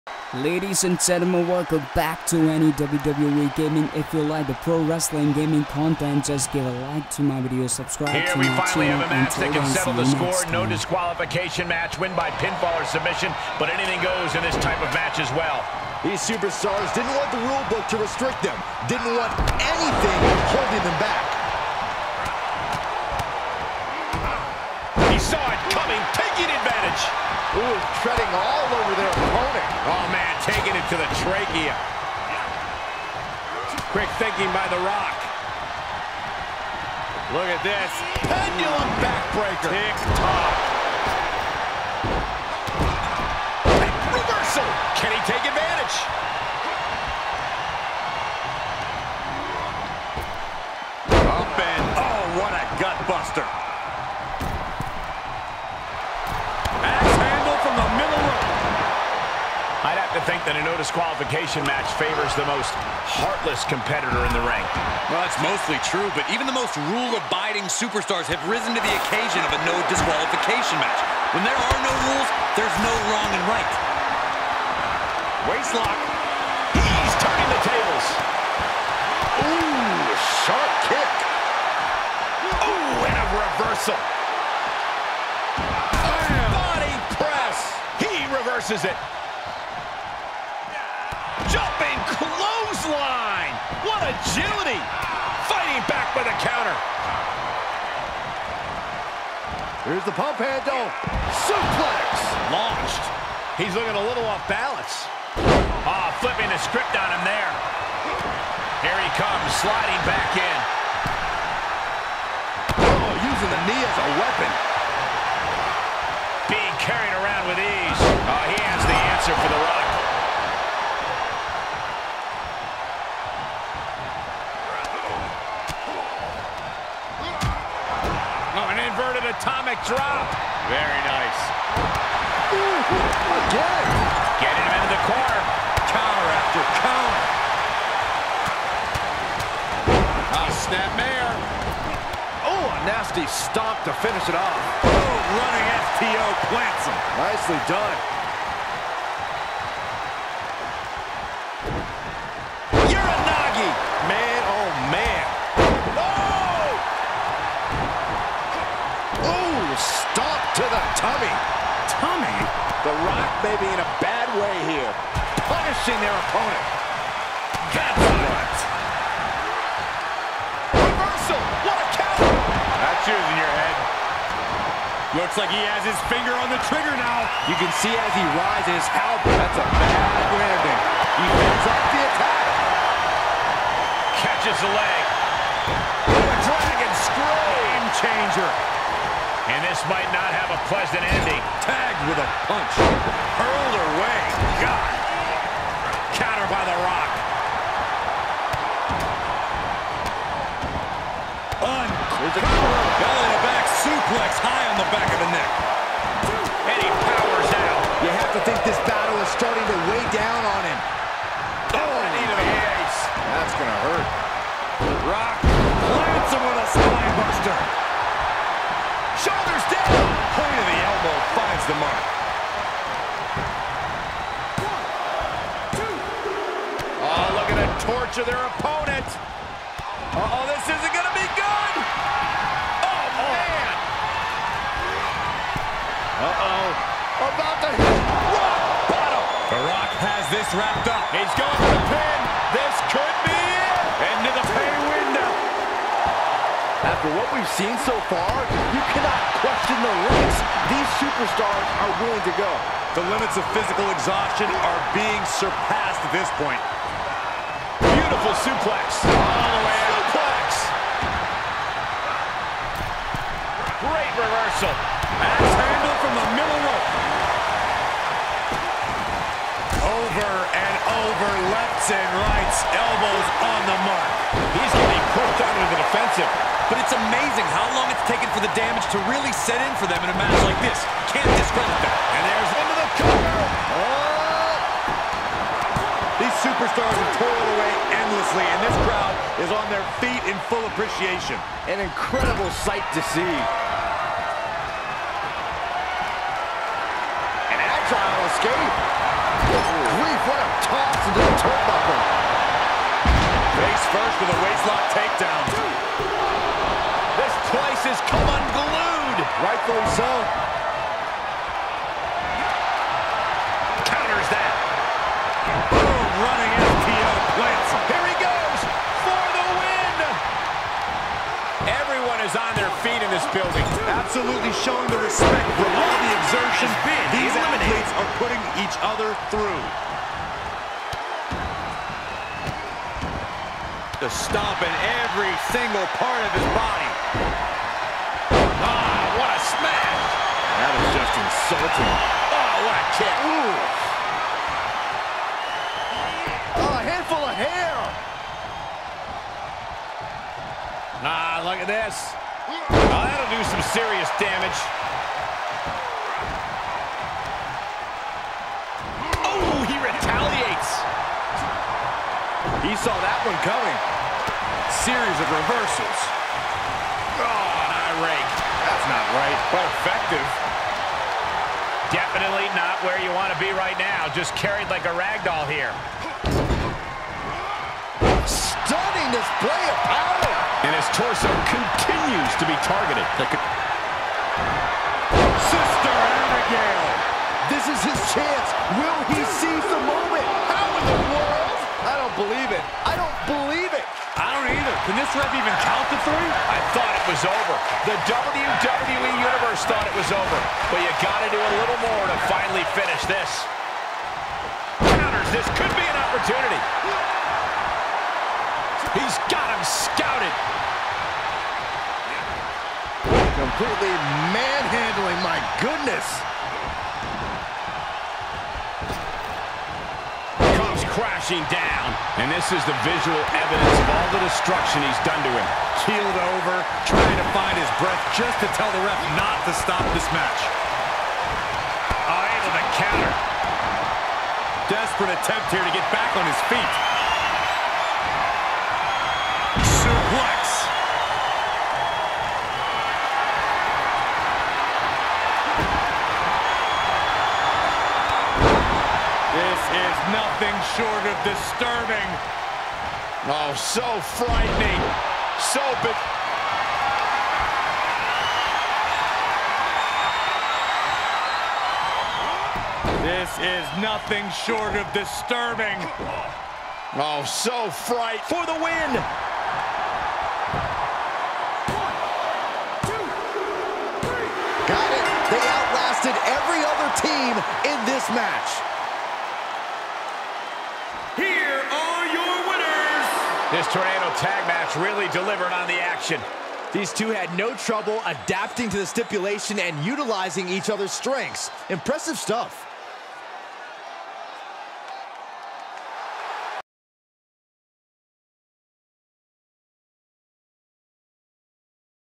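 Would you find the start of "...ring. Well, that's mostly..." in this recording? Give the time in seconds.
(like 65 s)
64 s.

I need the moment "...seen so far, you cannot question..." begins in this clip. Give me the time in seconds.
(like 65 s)
247 s.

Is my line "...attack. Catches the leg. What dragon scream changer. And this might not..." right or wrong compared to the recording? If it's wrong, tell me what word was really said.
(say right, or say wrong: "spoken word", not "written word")
right.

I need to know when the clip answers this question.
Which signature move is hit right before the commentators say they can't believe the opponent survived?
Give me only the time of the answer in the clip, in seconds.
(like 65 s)
385 s.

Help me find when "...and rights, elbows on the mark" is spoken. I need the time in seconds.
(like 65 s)
271 s.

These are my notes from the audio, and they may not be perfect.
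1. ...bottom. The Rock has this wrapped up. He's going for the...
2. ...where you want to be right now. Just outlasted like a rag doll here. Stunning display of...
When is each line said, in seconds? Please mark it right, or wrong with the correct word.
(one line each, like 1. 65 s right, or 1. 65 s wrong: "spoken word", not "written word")
1. 238 s right
2. 372 s wrong: "carried", not "outlasted".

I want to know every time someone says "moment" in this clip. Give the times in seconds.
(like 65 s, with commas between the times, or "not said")
389 s.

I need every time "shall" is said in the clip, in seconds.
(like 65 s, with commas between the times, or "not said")
not said.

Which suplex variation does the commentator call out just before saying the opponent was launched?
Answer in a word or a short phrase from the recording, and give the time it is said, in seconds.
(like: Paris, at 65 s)
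pump handle, at 100 s.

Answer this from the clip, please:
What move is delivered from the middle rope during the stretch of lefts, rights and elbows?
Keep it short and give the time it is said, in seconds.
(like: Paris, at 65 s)
Axe handle, at 265 s.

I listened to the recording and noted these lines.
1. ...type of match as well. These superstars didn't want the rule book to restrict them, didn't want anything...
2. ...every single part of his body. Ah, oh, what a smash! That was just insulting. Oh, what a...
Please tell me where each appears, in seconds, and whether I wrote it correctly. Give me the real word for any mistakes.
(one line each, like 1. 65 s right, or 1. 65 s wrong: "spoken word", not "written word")
1. 14 s right
2. 335 s right.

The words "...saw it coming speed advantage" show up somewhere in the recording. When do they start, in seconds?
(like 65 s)
25 s.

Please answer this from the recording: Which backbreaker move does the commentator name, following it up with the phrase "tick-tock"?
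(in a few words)
Pendulum backbreaker.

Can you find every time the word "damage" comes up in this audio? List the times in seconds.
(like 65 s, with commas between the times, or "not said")
278 s, 354 s.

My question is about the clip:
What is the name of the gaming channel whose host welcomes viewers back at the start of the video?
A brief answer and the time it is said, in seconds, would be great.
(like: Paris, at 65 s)
Anny WWE Gaming, at 2 s.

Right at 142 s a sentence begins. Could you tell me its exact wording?
Oh, a nasty stomp to finish it off.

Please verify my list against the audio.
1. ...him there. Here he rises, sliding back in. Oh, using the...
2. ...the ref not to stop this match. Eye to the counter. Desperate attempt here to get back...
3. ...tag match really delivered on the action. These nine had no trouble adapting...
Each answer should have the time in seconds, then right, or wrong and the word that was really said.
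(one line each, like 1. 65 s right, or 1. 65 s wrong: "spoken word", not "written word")
1. 107 s wrong: "comes", not "rises"
2. 428 s right
3. 484 s wrong: "two", not "nine".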